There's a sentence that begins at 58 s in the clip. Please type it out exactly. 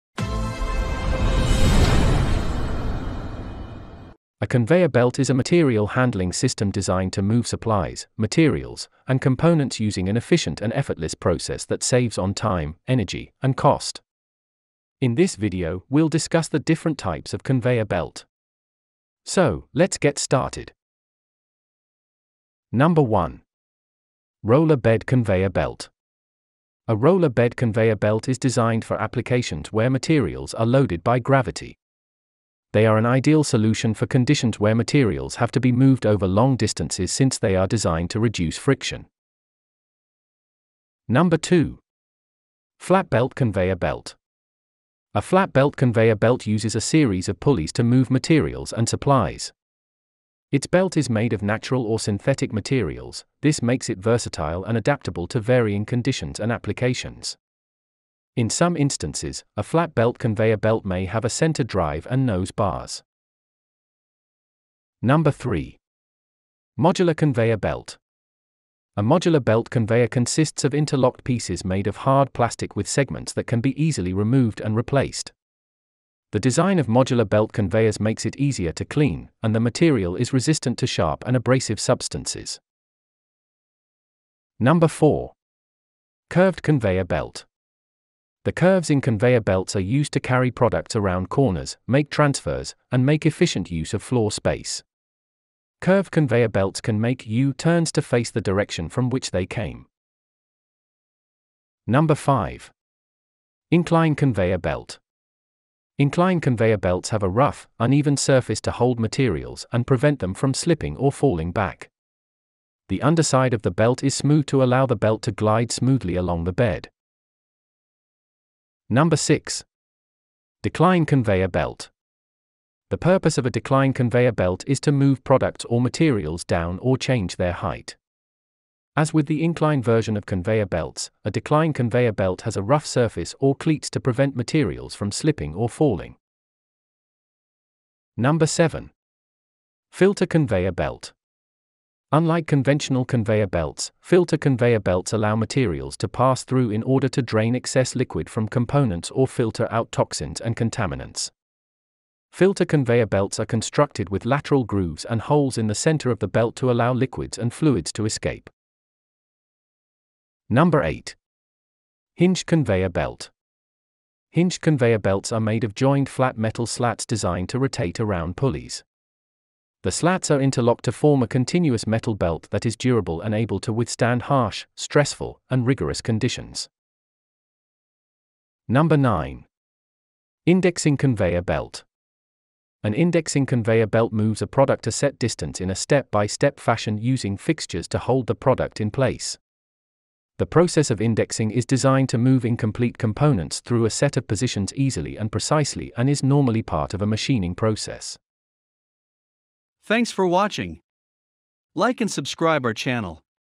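In some instances, a flat belt conveyor belt may have a center drive and nose bars.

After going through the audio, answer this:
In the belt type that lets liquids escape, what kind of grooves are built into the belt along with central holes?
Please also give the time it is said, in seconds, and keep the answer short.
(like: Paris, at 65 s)
Lateral grooves, at 154 s.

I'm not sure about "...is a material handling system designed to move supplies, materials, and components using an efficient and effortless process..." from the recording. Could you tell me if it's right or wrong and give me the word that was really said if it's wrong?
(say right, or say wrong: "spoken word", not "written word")
right.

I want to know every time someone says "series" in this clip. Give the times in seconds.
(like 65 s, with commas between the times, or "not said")
46 s.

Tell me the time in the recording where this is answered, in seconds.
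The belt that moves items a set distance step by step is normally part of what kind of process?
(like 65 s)
197 s.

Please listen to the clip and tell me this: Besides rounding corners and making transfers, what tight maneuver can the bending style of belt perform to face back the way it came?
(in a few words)
U turns.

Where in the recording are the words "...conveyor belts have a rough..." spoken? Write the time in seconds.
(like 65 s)
106 s.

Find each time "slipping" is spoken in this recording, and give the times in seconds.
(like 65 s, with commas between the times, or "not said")
110 s, 135 s.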